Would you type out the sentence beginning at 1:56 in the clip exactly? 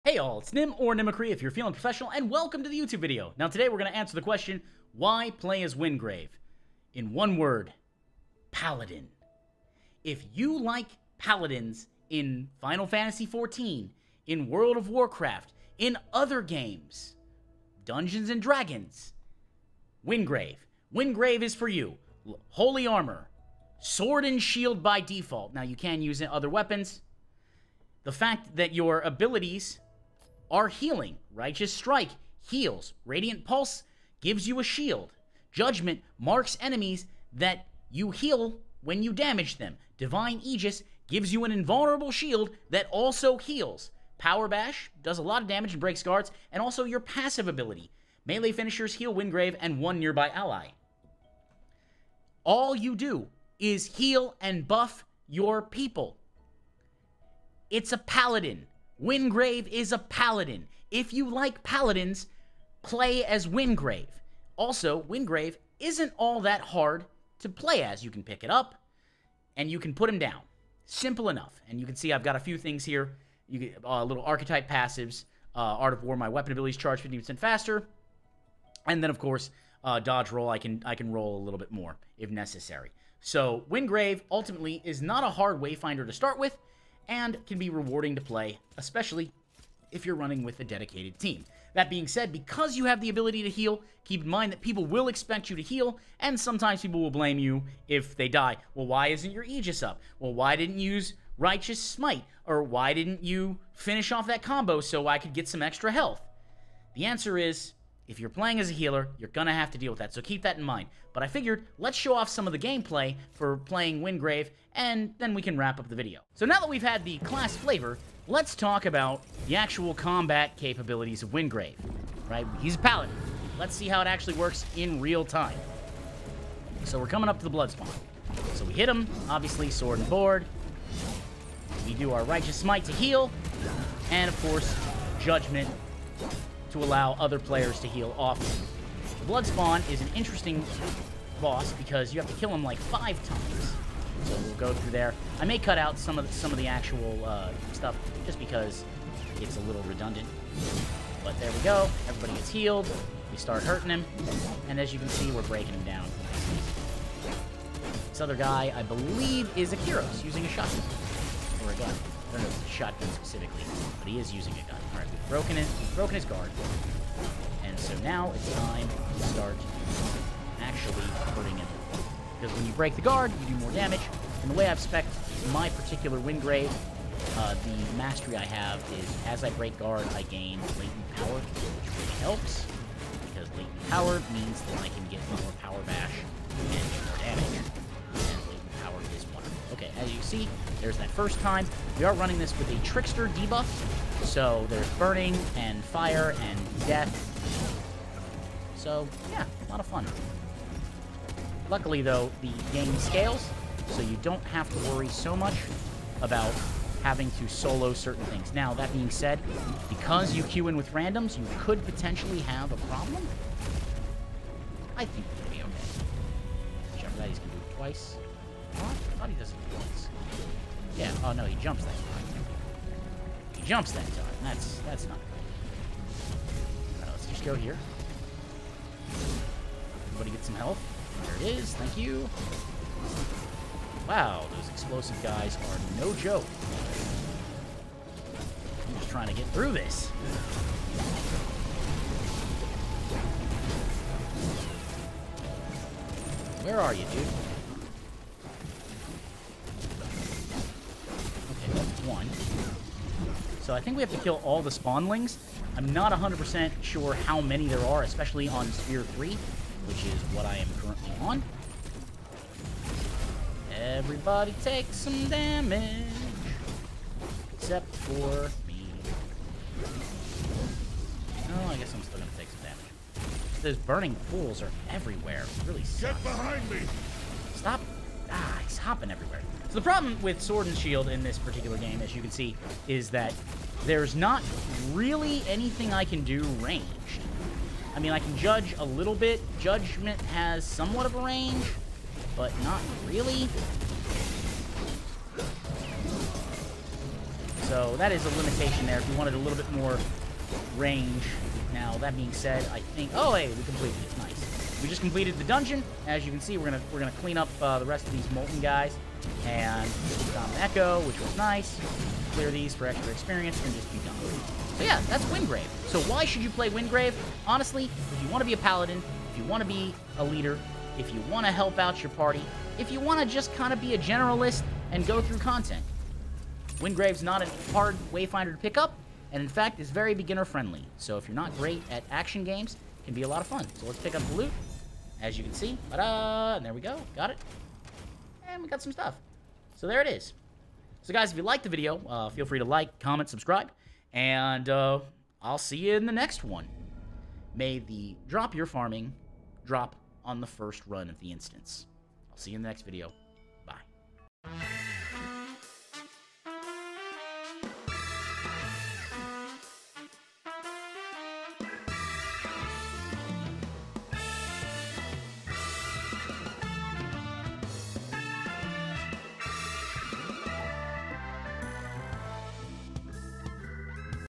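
So now that we've had the class flavor, let's talk about the actual combat capabilities of Wingrave, right?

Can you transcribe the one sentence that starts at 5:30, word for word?
So if you're not great at action games, it can be a lot of fun.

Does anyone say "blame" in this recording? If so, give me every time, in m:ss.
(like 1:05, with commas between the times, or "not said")
1:37.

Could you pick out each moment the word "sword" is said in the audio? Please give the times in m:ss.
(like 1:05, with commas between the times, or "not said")
0:23, 2:09, 4:40.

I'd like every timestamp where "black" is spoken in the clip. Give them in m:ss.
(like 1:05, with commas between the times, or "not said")
not said.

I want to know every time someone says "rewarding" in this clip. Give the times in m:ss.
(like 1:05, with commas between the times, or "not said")
1:27.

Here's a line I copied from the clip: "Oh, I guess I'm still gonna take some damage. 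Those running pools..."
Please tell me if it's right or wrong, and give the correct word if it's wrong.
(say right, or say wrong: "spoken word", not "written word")
wrong: "burning", not "running".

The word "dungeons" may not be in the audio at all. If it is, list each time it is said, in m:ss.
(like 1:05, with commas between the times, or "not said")
0:17, 5:05.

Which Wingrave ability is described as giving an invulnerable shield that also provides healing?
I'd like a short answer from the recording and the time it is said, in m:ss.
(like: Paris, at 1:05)
Divine Aegis, at 0:39.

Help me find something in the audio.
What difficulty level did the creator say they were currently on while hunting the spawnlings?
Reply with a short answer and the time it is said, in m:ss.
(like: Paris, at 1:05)
Sphere 3, at 4:18.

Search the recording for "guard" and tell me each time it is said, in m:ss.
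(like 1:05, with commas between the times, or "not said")
0:46, 2:46, 2:53, 2:59.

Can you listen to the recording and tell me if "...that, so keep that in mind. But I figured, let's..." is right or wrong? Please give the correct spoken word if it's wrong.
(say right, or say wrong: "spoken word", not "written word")
right.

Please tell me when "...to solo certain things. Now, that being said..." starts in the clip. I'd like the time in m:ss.
3:27.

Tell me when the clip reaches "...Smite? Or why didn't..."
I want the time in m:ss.
1:41.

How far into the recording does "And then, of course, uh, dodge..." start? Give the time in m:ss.
1:18.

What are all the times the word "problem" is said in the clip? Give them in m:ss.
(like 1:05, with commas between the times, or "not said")
3:32, 4:39.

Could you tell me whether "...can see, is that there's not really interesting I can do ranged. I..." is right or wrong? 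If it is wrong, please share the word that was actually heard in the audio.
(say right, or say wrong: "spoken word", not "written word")
wrong: "anything", not "interesting".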